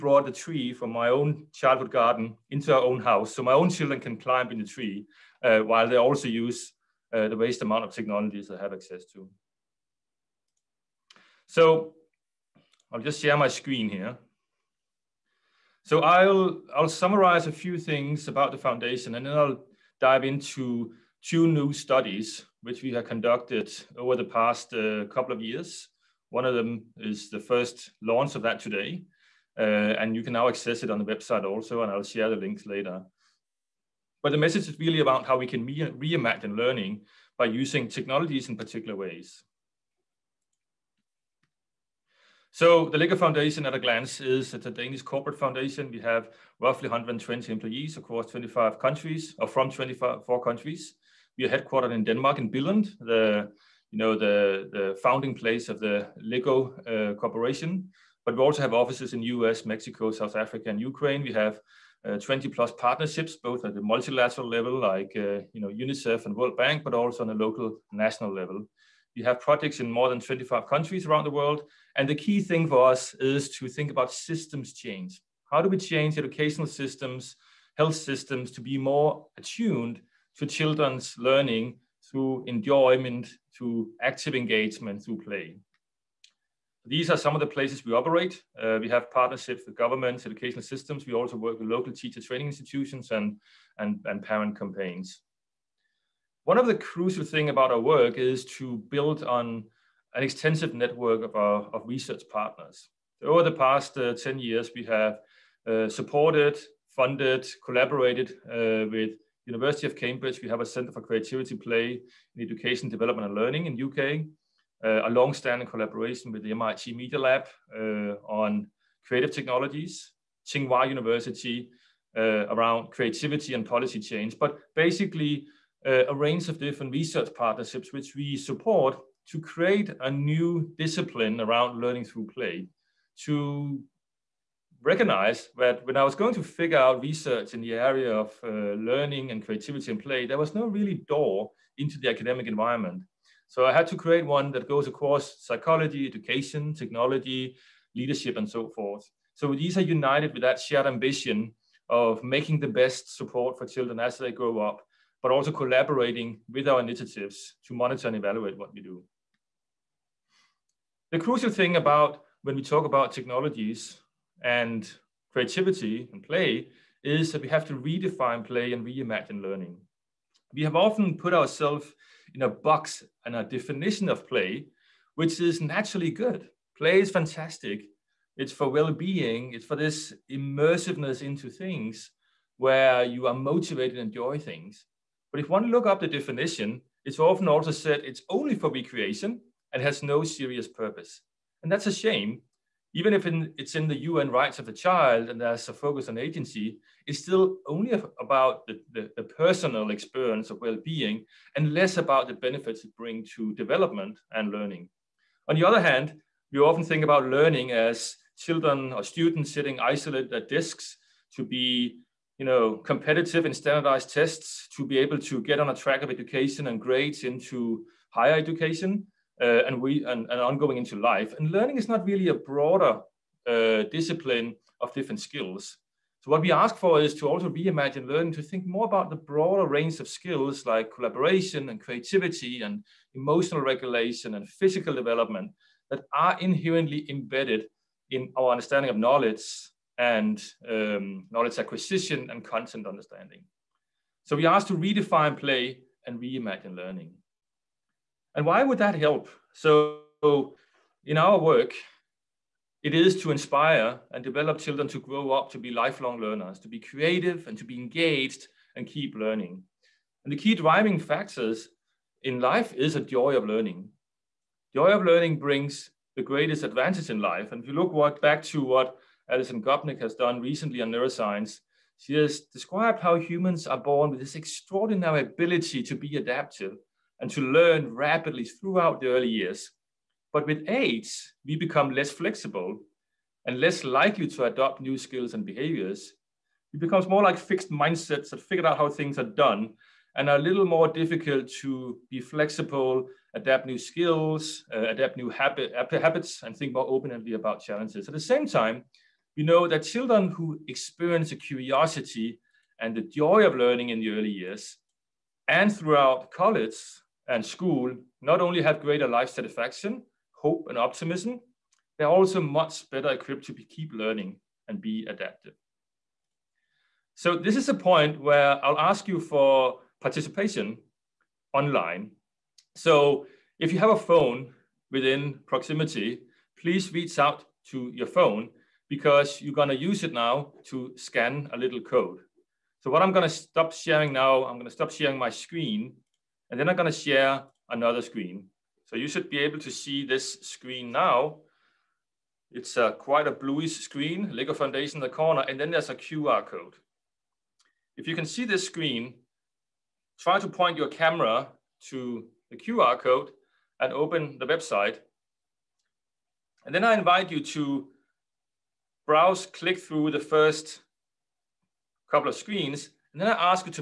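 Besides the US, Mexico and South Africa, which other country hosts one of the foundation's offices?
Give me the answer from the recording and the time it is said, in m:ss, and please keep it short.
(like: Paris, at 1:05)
Ukraine, at 1:00.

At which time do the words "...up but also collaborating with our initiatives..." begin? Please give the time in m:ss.
2:34.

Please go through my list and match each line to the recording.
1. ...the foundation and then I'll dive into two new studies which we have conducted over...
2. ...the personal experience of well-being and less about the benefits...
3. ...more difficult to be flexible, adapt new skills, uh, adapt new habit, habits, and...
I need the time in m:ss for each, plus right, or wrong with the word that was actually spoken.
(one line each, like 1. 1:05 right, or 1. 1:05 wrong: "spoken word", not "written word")
1. 0:18 right
2. 3:19 right
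3. 4:50 right.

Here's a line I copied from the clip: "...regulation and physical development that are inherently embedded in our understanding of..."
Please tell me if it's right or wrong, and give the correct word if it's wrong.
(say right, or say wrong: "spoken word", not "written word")
right.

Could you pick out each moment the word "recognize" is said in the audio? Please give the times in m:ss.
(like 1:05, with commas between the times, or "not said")
2:14.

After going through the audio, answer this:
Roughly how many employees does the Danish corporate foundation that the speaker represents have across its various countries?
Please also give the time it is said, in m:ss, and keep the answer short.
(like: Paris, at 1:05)
120, at 0:46.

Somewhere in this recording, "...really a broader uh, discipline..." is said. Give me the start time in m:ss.
3:42.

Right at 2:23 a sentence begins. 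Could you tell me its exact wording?
So I had to create one that goes across psychology, education, technology, leadership, and so forth.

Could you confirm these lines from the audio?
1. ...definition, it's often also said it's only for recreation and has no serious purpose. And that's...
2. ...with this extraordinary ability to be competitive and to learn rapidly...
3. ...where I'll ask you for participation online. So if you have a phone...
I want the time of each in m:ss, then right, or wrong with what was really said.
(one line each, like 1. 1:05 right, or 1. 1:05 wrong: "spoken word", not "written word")
1. 3:06 right
2. 4:34 wrong: "adaptive", not "competitive"
3. 5:18 right.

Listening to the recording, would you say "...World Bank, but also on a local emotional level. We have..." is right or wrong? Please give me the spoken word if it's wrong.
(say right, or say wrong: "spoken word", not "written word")
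wrong: "national", not "emotional".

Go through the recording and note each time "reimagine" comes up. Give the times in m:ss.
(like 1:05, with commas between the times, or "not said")
0:35, 2:48, 3:47, 4:06.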